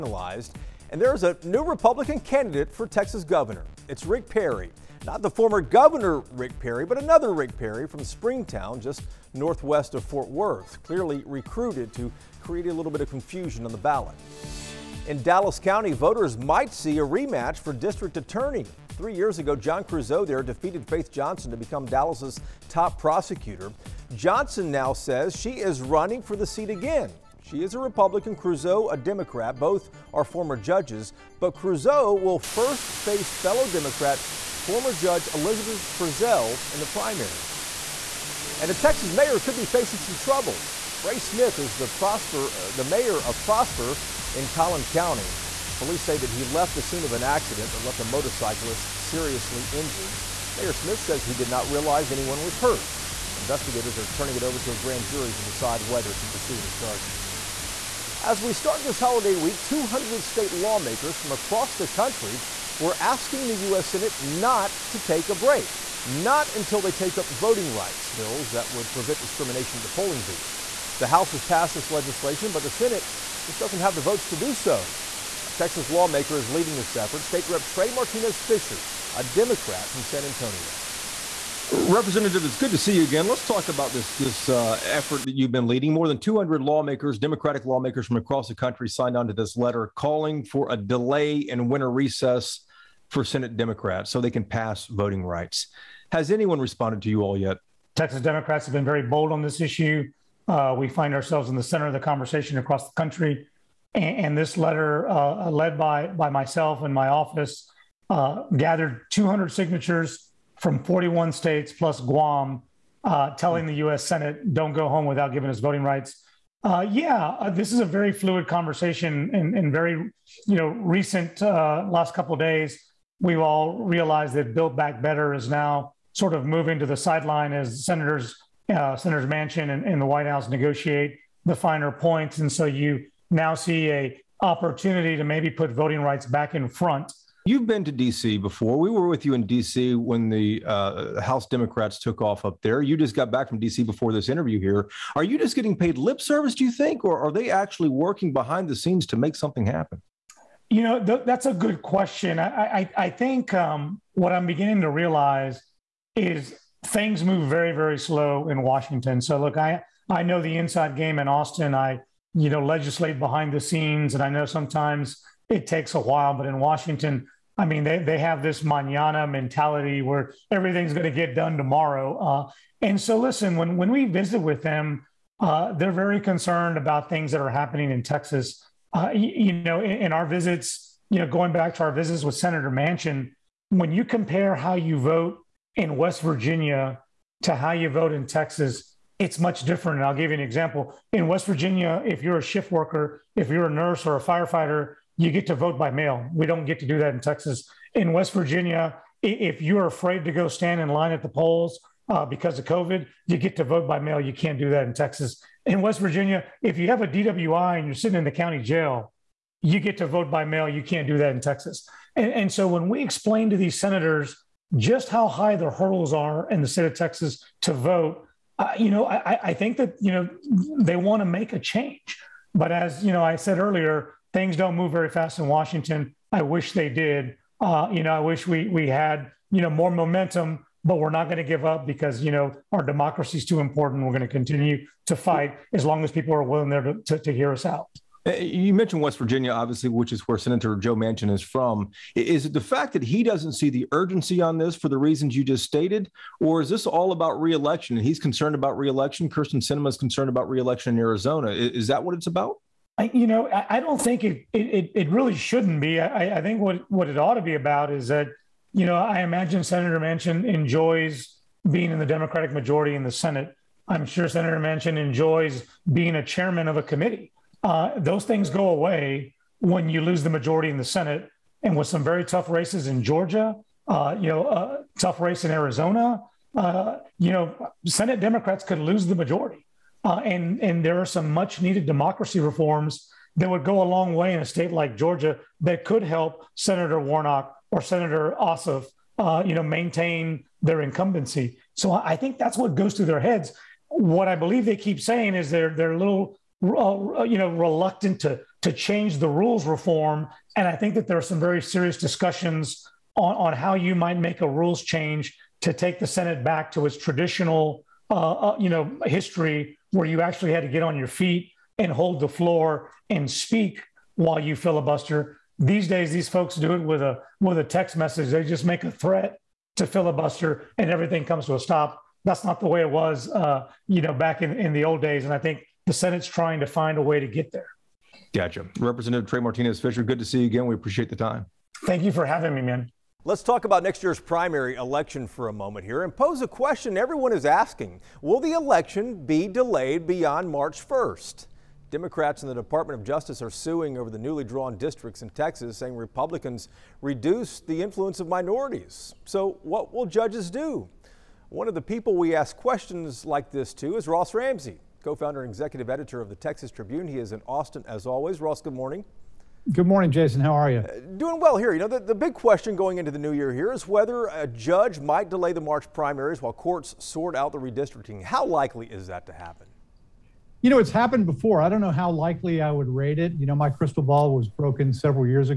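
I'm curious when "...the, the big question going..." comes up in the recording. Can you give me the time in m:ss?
6:01.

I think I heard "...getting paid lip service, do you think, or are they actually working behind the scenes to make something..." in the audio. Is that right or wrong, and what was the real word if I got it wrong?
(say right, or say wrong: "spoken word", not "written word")
right.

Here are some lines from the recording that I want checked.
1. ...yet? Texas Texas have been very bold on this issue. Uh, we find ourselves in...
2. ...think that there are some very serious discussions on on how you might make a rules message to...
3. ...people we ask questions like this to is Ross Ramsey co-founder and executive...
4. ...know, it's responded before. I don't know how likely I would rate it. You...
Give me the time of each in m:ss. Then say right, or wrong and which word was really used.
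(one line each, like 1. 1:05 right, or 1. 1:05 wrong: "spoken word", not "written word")
1. 1:37 wrong: "Democrats", not "Texas"
2. 5:00 wrong: "change", not "message"
3. 5:51 right
4. 6:10 wrong: "happened", not "responded".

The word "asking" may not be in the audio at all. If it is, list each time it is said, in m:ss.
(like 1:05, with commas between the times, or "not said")
1:03, 5:37.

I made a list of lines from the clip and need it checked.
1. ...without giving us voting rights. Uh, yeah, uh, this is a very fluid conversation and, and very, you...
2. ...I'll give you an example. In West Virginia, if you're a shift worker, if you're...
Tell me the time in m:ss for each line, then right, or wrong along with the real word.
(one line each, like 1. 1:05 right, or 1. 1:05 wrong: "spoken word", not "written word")
1. 1:55 right
2. 3:10 right.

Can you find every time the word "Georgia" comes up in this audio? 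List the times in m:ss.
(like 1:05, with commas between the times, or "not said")
4:33, 4:44.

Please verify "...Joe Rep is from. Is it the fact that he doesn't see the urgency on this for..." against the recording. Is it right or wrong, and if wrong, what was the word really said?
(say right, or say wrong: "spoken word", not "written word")
wrong: "Manchin", not "Rep".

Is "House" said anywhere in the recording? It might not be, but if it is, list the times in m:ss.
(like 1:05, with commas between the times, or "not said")
1:11, 2:10, 2:21.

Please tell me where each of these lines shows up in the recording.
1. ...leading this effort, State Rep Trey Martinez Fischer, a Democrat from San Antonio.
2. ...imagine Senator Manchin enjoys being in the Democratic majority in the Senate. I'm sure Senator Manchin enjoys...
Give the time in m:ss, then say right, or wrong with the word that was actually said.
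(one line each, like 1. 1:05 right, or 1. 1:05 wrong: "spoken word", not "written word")
1. 1:16 right
2. 4:19 right.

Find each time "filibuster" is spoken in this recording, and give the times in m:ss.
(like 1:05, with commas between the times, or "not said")
5:14, 5:19.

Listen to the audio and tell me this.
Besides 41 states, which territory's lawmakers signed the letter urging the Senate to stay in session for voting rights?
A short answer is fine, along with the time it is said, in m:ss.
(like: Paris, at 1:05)
Guam, at 1:52.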